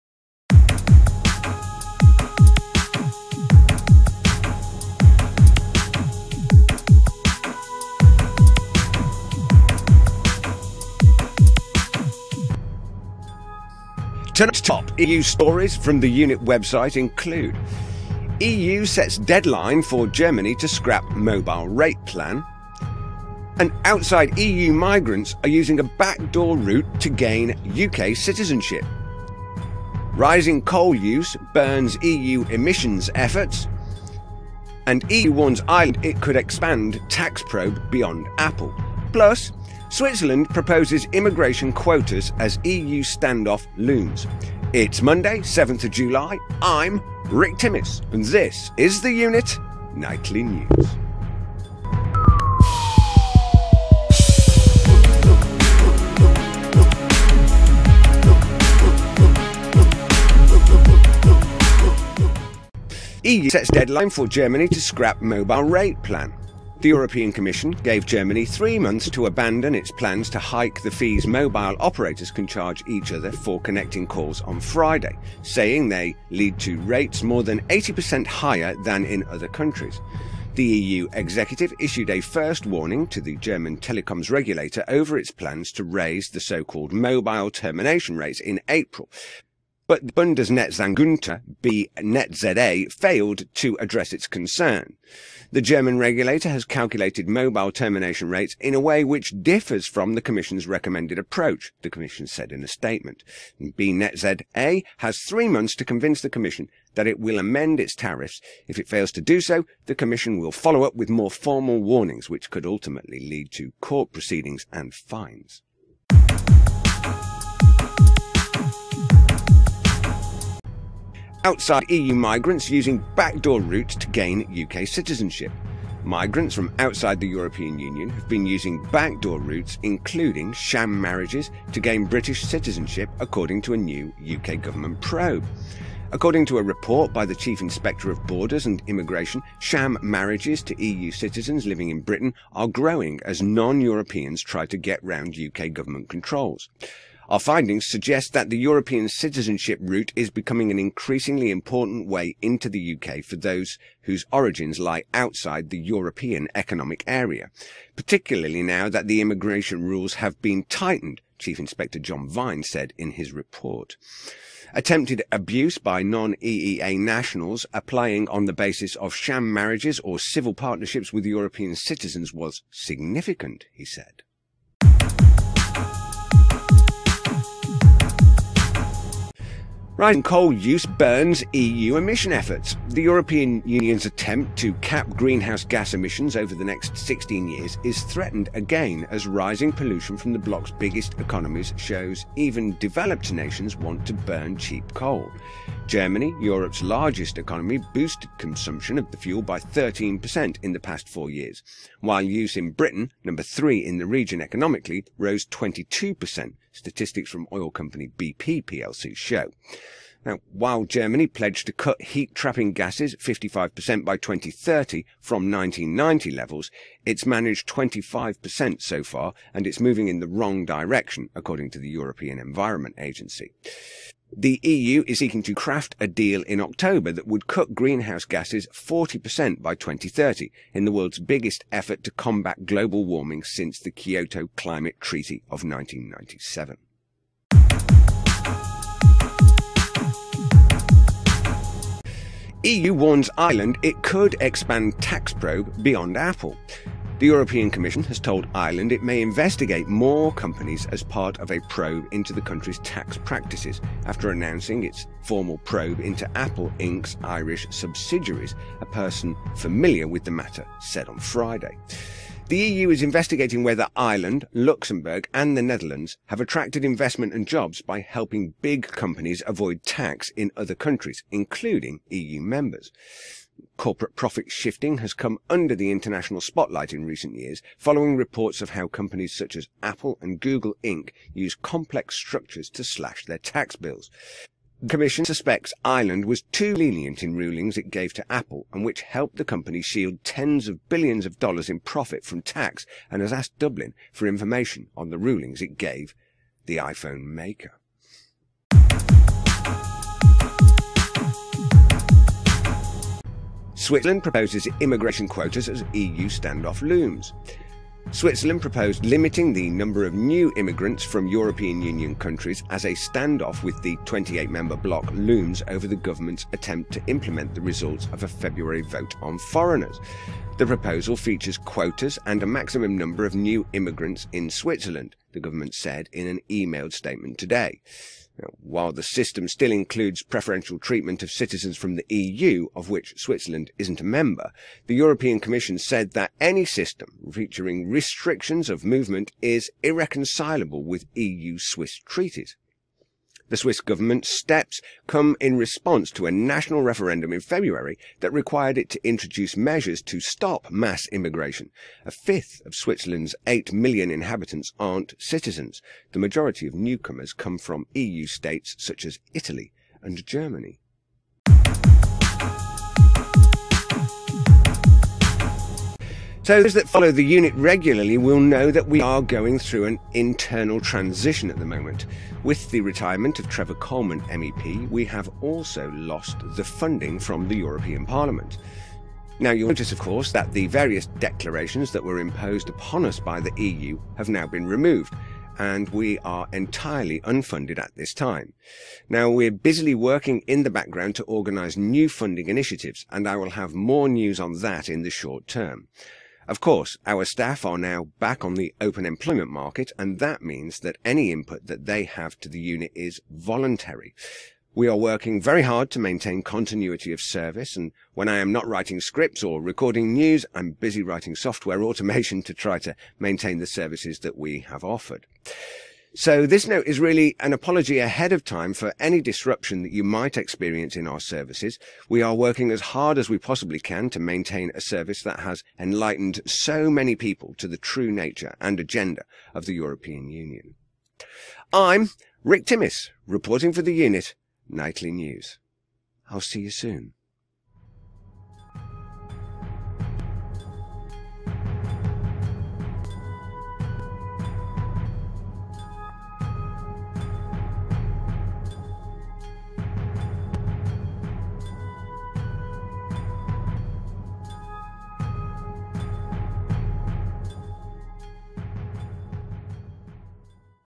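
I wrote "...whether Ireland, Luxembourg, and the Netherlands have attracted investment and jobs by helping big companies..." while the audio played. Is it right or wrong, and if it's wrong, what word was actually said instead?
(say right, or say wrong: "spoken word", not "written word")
right.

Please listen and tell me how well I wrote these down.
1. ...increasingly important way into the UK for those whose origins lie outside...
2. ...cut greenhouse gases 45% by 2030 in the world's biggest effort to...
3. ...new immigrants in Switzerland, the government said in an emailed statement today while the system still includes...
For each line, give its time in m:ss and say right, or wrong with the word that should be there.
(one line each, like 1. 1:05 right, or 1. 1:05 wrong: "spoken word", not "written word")
1. 2:30 right
2. 3:47 wrong: "40", not "45"
3. 5:23 right.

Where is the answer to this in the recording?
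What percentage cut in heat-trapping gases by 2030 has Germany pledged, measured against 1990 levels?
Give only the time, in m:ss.
3:33.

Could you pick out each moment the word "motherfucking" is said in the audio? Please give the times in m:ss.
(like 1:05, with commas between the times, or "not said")
not said.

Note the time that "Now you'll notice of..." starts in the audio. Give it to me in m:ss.
6:19.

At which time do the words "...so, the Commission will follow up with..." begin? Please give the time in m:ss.
1:49.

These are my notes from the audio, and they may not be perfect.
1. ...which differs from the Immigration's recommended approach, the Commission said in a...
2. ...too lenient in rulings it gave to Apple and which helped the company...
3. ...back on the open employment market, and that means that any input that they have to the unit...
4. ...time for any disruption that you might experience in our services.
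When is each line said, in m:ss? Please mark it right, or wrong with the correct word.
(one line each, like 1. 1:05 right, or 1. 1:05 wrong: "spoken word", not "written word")
1. 1:39 wrong: "Commission", not "Immigration"
2. 4:46 right
3. 6:38 right
4. 6:58 right.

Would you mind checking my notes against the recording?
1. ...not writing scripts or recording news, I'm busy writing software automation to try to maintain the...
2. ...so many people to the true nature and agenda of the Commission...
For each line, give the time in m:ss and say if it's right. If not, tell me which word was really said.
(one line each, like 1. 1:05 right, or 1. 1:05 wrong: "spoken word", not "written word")
1. 6:48 right
2. 7:06 wrong: "European", not "Commission".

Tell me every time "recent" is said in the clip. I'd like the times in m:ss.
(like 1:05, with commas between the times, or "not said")
4:37.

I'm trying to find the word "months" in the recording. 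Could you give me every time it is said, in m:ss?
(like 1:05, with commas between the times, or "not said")
1:08, 1:45.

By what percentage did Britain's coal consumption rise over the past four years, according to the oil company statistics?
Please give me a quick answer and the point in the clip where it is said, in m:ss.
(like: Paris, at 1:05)
22%, at 3:25.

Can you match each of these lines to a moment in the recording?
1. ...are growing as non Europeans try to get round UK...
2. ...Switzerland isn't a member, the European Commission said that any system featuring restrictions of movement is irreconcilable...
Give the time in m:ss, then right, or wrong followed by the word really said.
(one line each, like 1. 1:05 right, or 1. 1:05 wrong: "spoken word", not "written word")
1. 2:22 right
2. 5:33 right.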